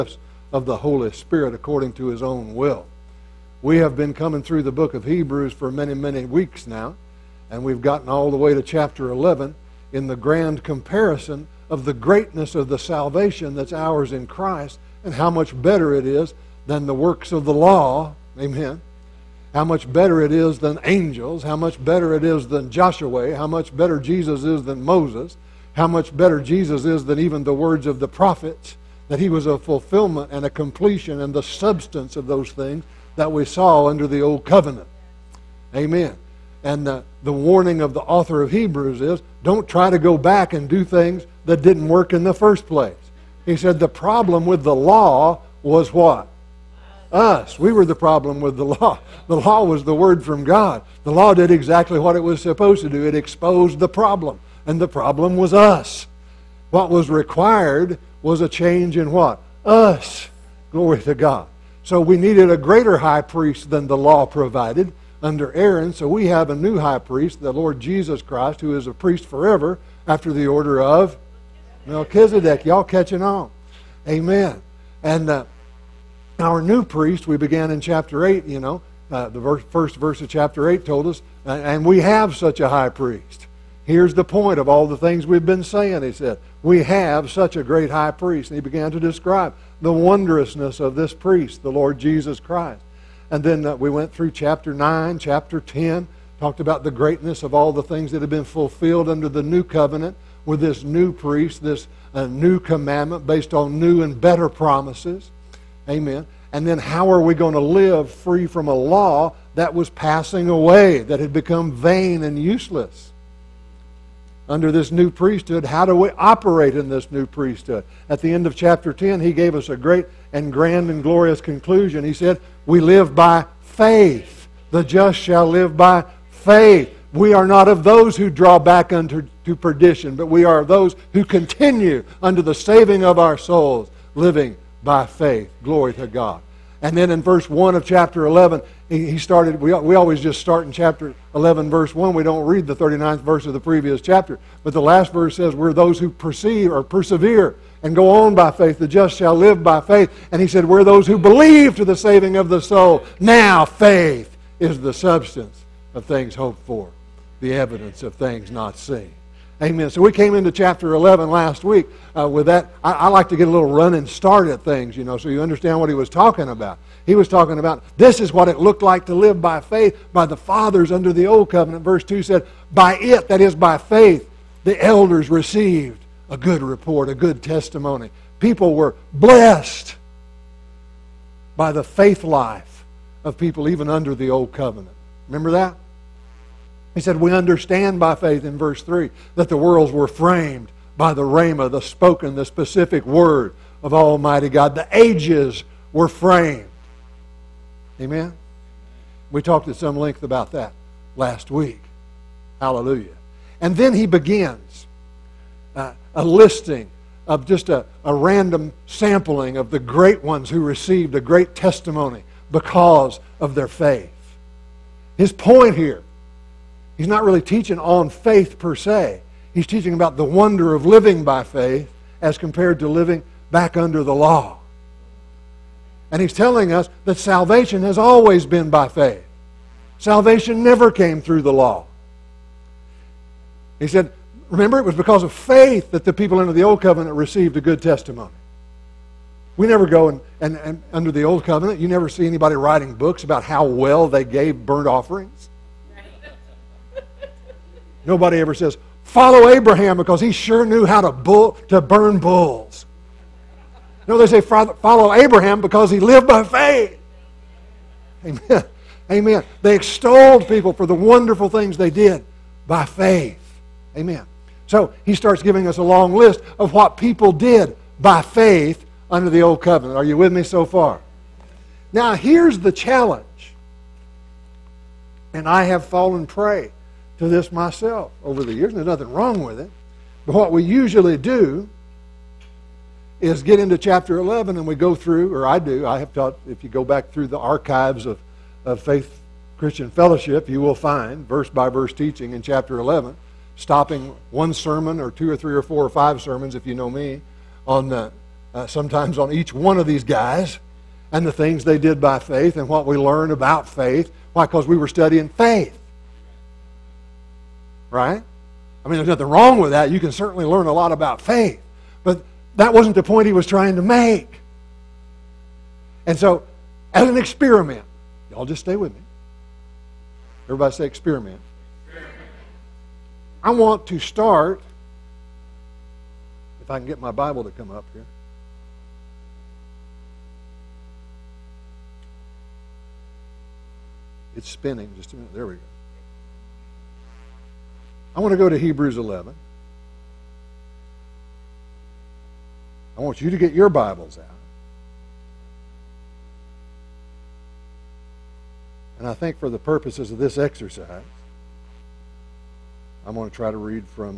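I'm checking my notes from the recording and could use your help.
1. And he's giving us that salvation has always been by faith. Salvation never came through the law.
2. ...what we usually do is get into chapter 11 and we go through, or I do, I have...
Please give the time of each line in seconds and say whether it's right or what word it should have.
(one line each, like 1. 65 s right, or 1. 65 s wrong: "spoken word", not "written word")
1. 226 s wrong: "telling", not "giving"
2. 280 s right.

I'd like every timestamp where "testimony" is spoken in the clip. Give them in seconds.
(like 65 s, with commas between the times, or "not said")
177 s, 211 s, 237 s.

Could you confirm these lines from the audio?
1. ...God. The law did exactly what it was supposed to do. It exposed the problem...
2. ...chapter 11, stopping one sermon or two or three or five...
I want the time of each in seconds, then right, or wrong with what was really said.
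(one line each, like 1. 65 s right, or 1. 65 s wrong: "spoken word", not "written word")
1. 50 s right
2. 292 s wrong: "four", not "five".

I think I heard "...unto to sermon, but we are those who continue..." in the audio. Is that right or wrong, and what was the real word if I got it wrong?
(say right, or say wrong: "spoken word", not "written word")
wrong: "perdition", not "sermon".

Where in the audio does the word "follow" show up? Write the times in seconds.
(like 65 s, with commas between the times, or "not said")
249 s, 254 s.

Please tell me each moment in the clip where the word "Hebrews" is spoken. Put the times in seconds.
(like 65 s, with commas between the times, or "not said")
5 s, 38 s, 338 s.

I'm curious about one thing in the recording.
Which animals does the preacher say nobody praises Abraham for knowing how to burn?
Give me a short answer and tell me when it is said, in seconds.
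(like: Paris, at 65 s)
bulls, at 252 s.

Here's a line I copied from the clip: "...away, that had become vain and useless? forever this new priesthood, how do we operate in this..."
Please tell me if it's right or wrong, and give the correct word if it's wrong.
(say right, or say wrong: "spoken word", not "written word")
wrong: "under", not "forever".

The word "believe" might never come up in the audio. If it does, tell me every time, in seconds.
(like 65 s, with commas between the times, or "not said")
151 s.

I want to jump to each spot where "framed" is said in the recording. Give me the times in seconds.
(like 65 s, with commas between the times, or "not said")
190 s, 196 s.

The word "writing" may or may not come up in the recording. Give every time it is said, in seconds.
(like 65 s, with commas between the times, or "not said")
242 s.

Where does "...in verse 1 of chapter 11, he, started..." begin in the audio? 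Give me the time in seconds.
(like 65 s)
137 s.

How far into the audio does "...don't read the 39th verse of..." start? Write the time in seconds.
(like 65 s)
142 s.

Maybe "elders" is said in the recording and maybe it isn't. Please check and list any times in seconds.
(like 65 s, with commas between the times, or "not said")
174 s.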